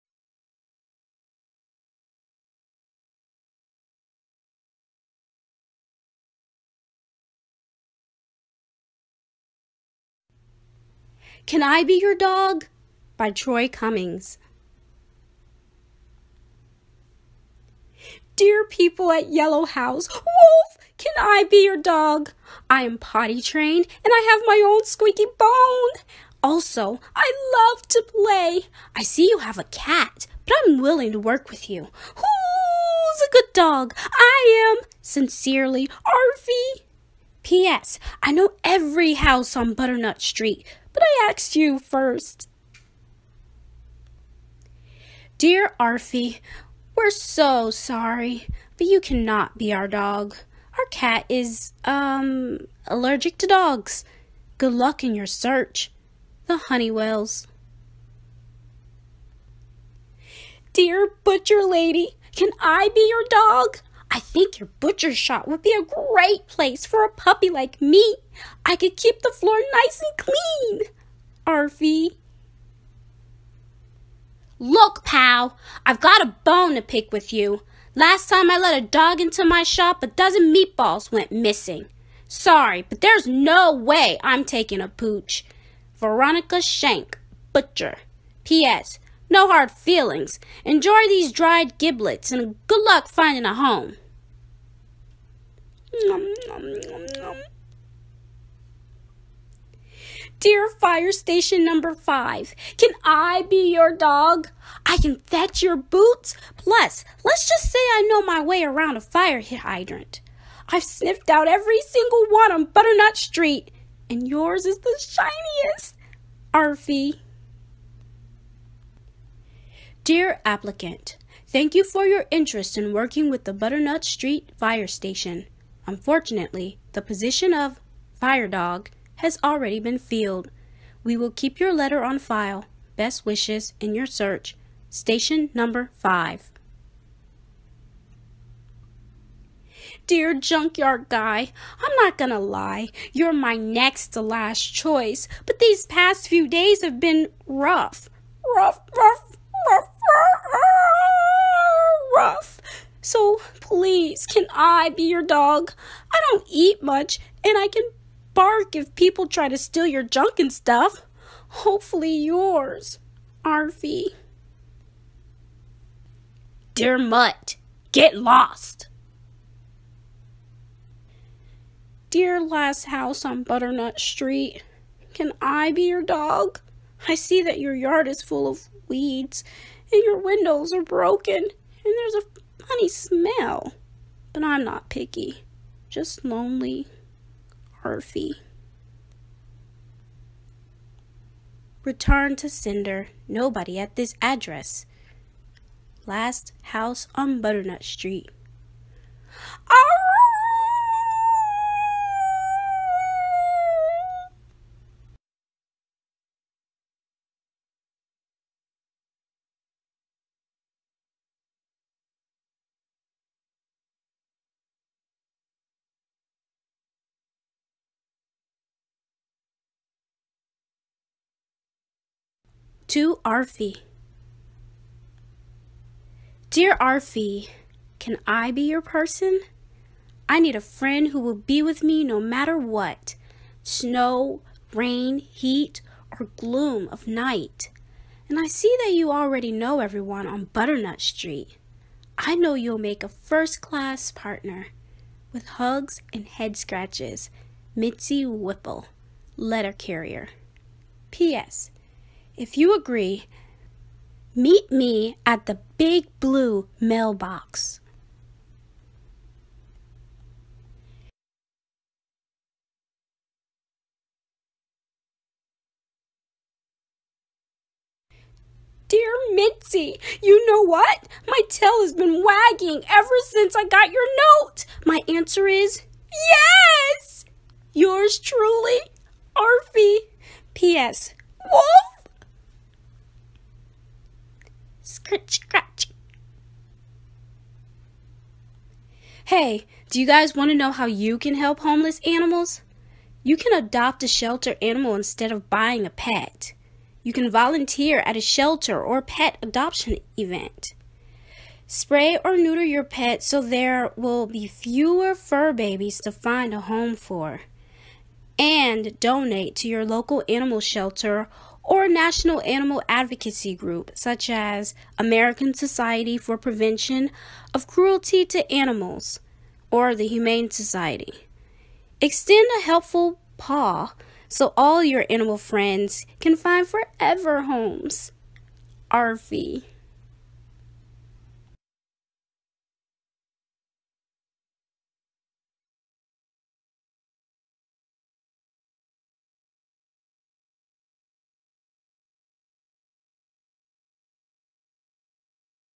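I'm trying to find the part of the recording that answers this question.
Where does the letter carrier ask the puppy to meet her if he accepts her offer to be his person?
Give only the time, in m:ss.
4:15.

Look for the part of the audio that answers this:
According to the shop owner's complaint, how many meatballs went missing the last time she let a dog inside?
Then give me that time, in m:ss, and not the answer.
1:20.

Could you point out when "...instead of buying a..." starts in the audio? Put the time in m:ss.
4:54.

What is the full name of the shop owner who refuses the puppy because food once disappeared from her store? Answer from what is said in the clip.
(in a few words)
Veronica Shank.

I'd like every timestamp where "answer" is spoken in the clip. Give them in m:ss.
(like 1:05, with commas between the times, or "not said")
4:35.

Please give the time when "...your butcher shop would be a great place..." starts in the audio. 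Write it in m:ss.
1:04.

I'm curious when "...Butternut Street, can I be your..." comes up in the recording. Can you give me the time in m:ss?
2:53.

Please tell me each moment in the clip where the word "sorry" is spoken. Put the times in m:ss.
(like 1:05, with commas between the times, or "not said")
0:47, 1:22.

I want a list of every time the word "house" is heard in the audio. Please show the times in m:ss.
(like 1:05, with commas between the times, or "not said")
0:19, 0:39, 2:52, 3:16.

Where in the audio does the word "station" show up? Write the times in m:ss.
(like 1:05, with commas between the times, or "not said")
1:41, 2:04, 2:14.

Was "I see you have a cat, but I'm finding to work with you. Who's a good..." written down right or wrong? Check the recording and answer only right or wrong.
wrong.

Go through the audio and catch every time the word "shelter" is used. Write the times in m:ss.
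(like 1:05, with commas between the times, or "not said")
4:54, 4:58, 5:10.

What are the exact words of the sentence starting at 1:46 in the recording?
Plus, let's just say I know my way around a fire hydrant.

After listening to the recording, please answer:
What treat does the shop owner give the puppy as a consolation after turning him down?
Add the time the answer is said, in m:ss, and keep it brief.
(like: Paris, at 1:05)
Dried giblets, at 1:31.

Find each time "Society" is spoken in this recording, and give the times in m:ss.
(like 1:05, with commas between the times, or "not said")
5:15, 5:20.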